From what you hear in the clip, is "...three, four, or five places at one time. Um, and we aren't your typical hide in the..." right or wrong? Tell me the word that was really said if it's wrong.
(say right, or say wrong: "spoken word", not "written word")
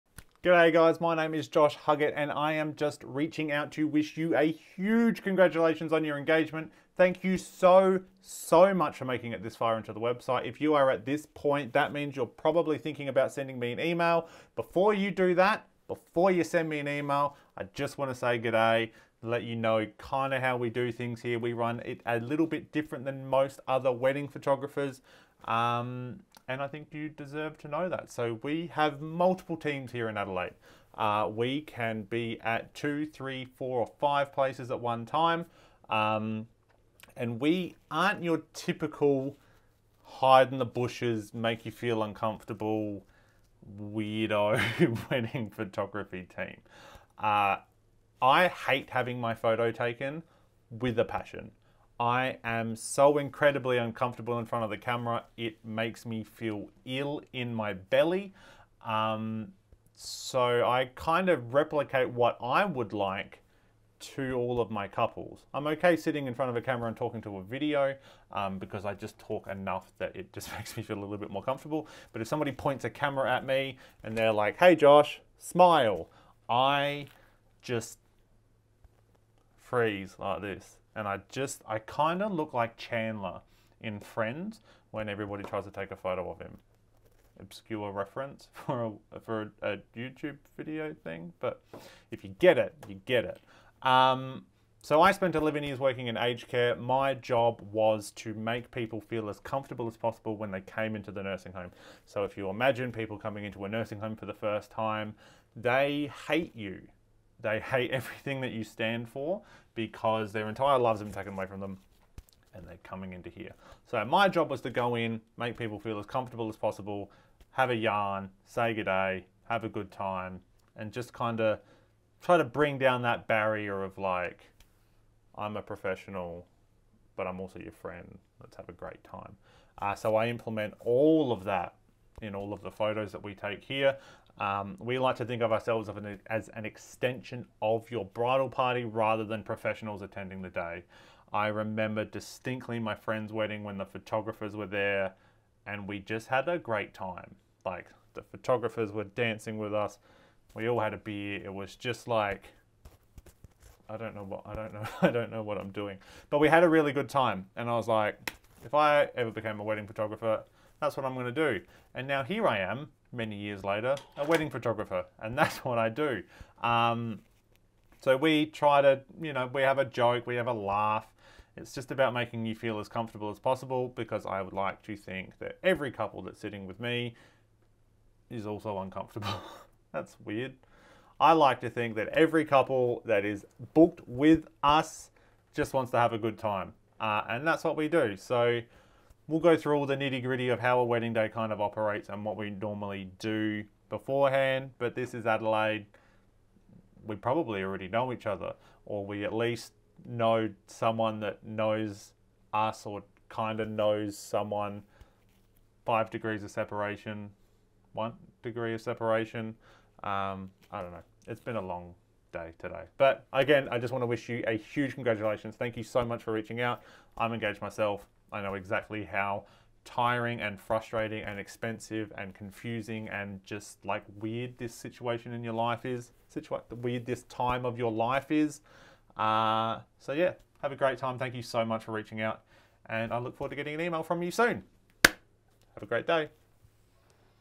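right.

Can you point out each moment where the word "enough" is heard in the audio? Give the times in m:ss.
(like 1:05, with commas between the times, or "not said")
1:09.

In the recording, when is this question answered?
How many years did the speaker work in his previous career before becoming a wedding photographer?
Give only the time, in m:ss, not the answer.
1:35.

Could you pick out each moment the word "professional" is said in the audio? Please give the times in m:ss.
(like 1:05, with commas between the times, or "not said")
2:05, 2:19.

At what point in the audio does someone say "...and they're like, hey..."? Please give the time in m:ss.
1:14.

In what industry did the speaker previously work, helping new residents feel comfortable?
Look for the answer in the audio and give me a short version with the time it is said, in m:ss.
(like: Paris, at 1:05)
aged care, at 1:36.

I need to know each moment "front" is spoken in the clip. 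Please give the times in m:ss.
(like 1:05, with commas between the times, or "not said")
0:54, 1:06.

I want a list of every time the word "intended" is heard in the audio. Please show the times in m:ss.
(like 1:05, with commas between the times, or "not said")
not said.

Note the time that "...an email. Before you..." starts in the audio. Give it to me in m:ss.
0:13.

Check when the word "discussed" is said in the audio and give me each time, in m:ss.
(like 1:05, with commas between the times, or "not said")
not said.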